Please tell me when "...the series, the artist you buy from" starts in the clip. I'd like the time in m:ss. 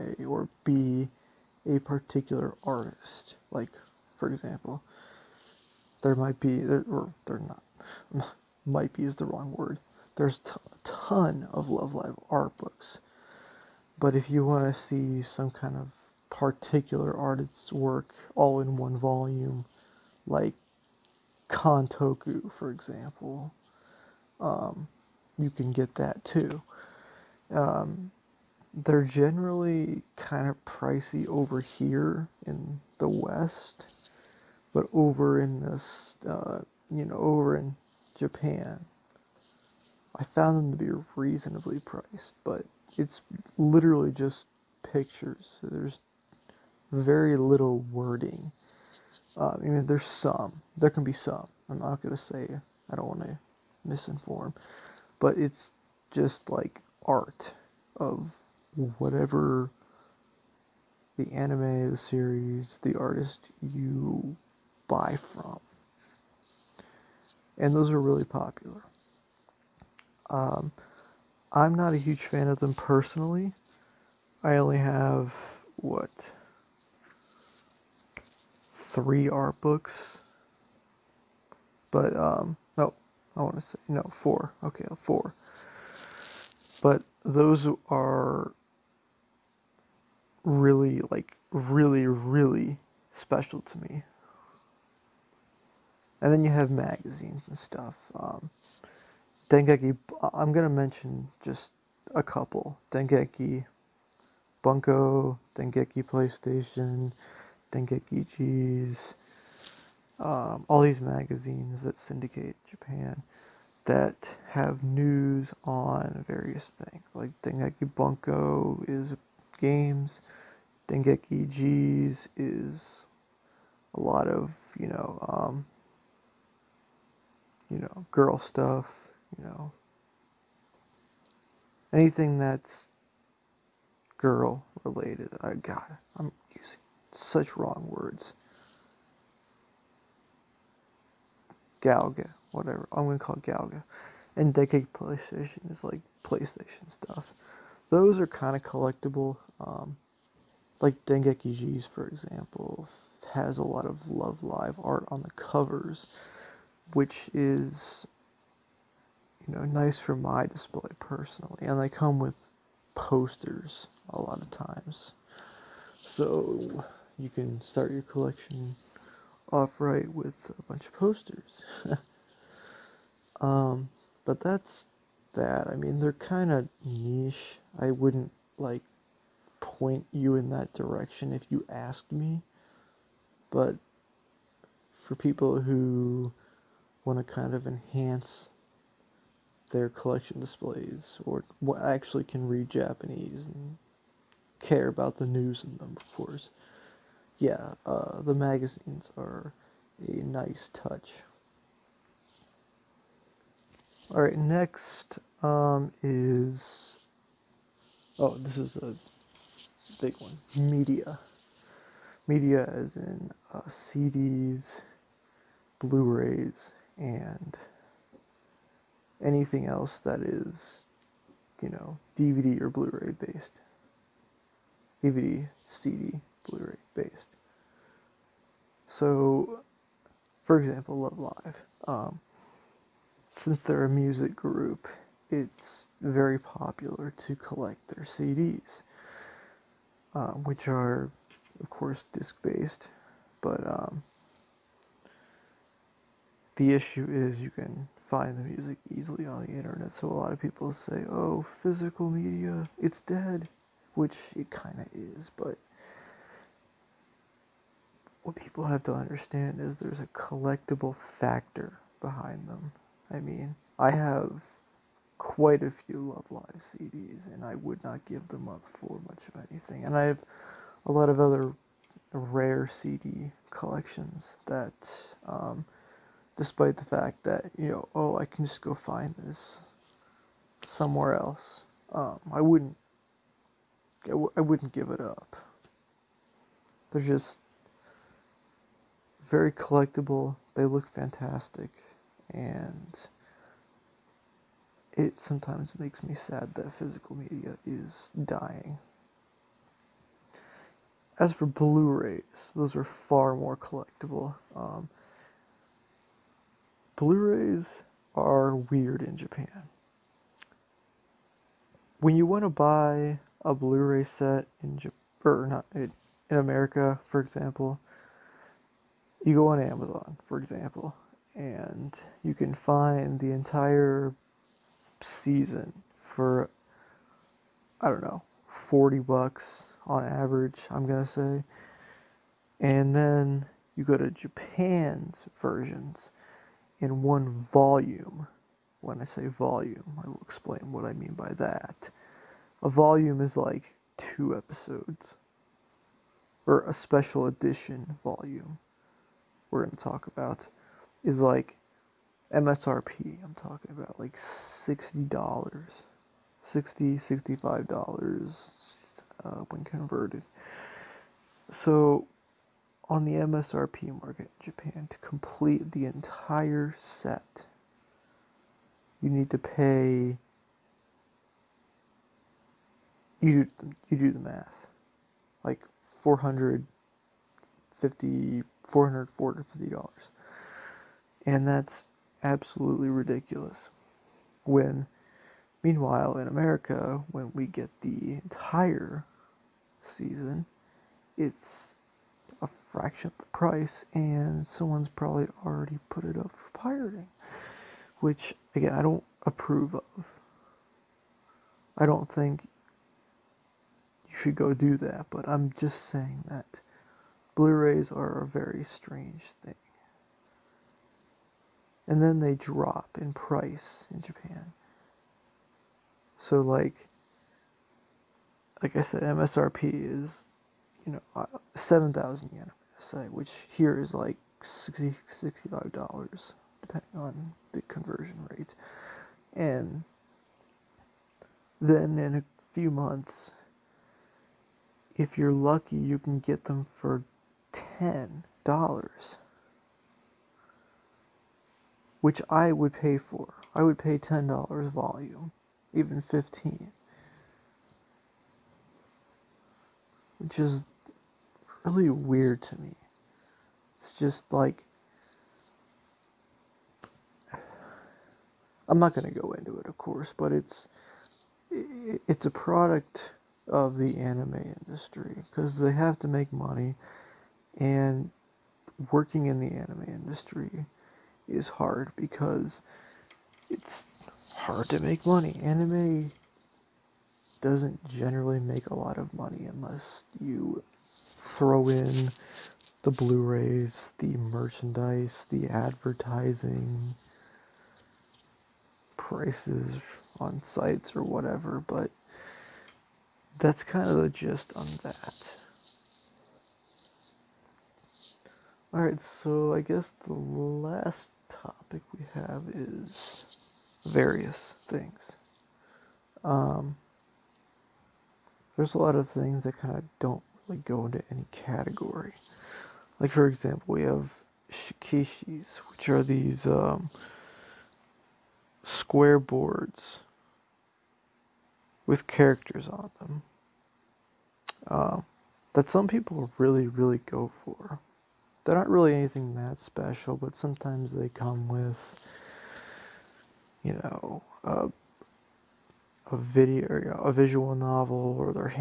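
1:01.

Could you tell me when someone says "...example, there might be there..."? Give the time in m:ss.
0:04.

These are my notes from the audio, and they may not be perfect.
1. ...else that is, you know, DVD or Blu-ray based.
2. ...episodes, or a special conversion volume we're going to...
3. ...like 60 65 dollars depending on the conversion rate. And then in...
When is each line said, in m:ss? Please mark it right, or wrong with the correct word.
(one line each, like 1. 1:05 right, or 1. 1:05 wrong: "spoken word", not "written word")
1. 3:39 right
2. 5:44 wrong: "edition", not "conversion"
3. 7:03 right.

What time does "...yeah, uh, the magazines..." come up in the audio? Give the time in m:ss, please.
3:17.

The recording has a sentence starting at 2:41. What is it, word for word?
And they come with posters a lot of times.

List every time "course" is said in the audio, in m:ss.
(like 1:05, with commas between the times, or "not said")
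3:16, 4:01, 7:39.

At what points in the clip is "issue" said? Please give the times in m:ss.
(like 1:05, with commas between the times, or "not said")
4:06.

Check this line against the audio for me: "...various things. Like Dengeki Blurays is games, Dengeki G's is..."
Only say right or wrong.
wrong.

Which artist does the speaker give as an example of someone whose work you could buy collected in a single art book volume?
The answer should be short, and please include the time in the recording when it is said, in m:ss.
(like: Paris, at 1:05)
Kantoku, at 0:21.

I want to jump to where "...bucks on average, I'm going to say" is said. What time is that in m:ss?
5:28.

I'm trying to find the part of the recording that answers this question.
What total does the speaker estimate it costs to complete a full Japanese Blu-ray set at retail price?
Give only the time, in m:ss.
6:18.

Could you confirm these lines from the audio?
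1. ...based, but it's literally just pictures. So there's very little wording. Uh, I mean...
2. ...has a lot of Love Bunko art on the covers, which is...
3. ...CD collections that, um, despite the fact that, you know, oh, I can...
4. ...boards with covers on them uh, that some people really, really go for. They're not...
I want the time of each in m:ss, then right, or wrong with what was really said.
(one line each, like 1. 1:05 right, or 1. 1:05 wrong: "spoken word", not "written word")
1. 0:41 wrong: "priced", not "based"
2. 2:33 wrong: "Live", not "Bunko"
3. 4:32 right
4. 8:39 wrong: "characters", not "covers".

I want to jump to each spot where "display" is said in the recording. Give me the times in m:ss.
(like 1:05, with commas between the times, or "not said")
2:40, 3:10.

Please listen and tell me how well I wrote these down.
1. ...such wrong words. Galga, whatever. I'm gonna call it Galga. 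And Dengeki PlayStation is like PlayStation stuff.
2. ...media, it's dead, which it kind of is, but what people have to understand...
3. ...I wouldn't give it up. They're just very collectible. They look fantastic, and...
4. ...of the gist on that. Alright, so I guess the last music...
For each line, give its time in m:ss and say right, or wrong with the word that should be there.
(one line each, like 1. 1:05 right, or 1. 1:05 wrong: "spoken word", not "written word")
1. 2:17 right
2. 4:12 right
3. 4:44 right
4. 8:13 wrong: "topic", not "music".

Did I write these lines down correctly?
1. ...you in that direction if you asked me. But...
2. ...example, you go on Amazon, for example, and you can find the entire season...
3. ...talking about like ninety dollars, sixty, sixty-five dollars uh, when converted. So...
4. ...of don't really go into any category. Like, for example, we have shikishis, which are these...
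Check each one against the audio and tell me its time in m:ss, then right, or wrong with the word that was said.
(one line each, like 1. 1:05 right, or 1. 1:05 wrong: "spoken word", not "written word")
1. 3:00 right
2. 5:17 right
3. 5:53 wrong: "sixty", not "ninety"
4. 8:29 right.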